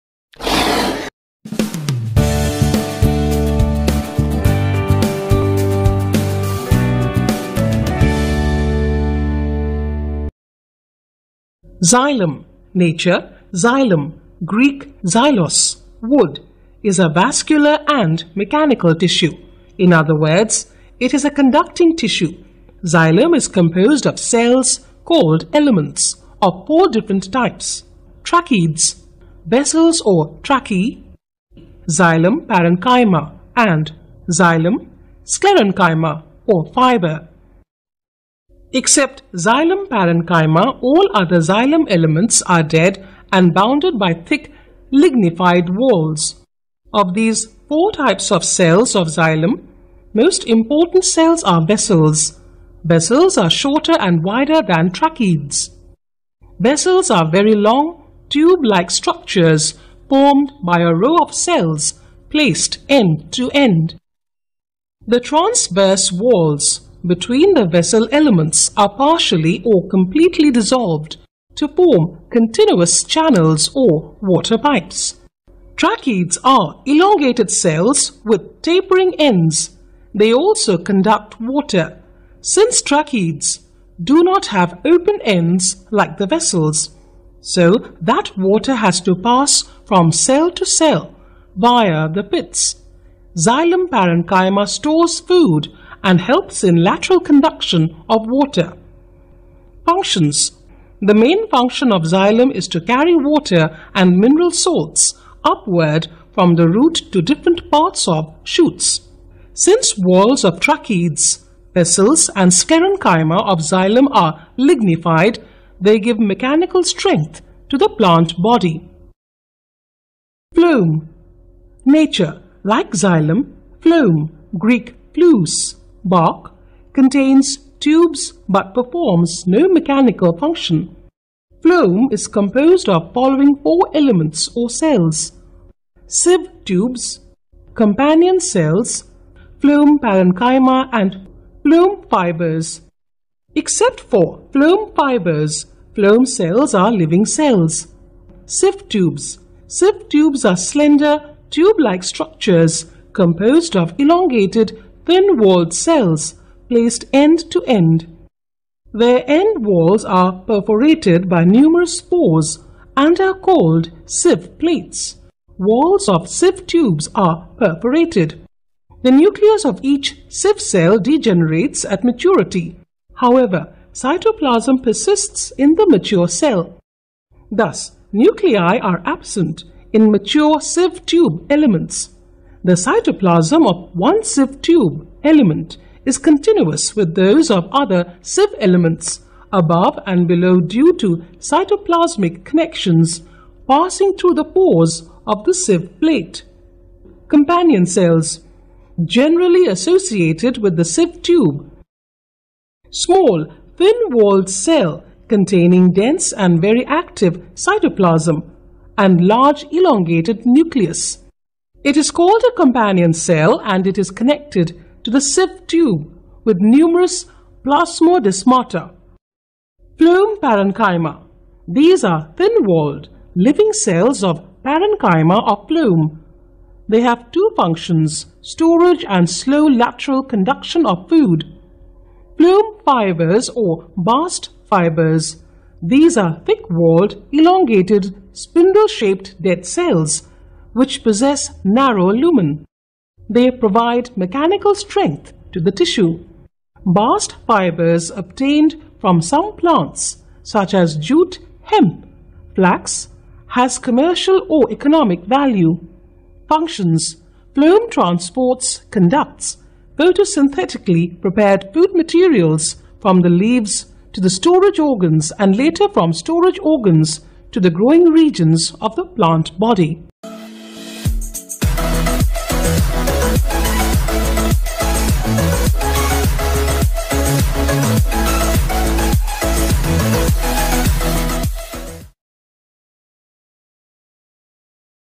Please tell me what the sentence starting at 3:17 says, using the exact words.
Companion cells, generally associated with the sieve tube.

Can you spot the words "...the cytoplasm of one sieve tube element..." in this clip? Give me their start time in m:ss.
3:02.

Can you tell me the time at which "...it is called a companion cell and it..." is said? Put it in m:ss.
3:31.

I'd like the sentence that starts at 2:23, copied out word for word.
Except for phloem fibers, phloem cells are living cells.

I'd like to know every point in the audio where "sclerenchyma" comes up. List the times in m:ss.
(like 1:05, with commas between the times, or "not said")
0:35, 1:52.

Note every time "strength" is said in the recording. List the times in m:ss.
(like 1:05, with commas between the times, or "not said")
1:56, 4:04.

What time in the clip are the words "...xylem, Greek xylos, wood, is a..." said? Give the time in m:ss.
0:13.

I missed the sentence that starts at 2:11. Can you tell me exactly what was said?
Phloem is composed of following four elements or cells.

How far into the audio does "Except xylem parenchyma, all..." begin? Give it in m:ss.
0:38.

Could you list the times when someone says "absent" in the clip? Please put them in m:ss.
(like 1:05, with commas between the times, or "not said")
2:59.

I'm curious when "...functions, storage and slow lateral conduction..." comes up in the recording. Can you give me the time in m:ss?
3:47.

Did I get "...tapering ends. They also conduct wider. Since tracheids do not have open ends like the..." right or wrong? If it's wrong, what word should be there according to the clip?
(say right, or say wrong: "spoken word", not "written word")
wrong: "water", not "wider".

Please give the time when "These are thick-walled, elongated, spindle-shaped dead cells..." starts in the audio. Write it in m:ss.
3:55.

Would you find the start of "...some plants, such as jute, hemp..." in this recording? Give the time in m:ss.
4:09.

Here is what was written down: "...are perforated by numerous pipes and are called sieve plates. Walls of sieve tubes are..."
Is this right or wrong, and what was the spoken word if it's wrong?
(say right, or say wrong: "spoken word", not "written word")
wrong: "pores", not "pipes".